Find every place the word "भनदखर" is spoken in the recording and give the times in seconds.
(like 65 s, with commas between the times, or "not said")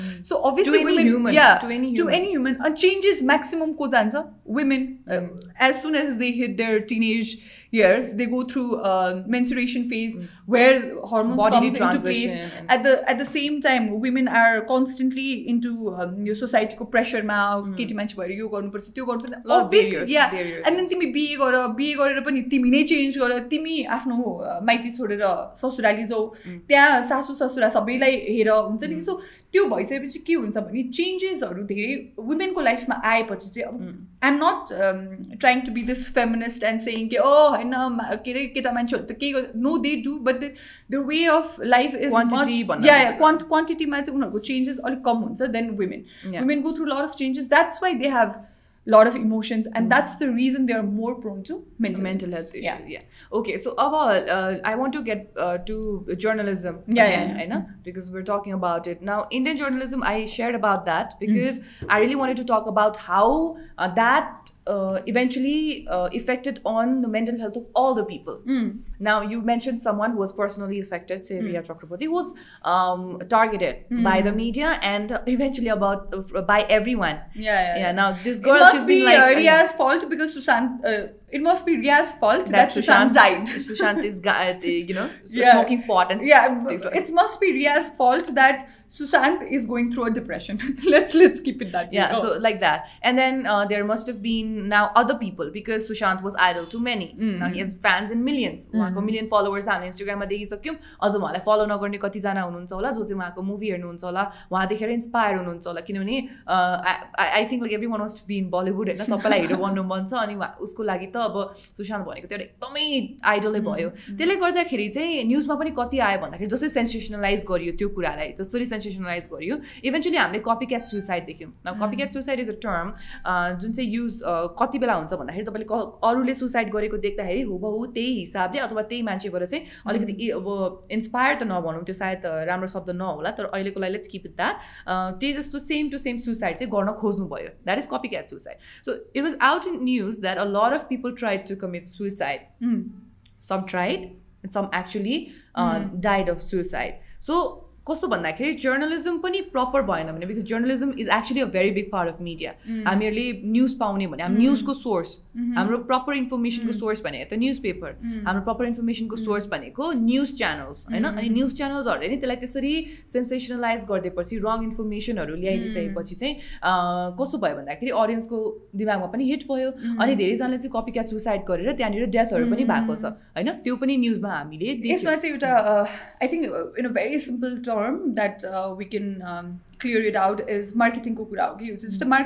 125 s, 148 s, 167 s.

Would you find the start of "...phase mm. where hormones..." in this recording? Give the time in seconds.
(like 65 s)
9 s.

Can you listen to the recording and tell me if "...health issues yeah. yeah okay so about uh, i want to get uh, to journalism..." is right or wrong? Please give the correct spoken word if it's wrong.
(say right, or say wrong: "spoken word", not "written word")
right.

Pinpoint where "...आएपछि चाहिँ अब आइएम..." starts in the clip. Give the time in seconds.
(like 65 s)
33 s.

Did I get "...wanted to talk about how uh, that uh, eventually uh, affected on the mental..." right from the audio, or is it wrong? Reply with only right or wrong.
right.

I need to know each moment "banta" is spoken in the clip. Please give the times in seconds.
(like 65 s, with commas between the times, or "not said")
116 s.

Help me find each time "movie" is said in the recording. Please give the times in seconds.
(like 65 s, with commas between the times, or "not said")
103 s.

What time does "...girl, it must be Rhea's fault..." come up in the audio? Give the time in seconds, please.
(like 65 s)
78 s.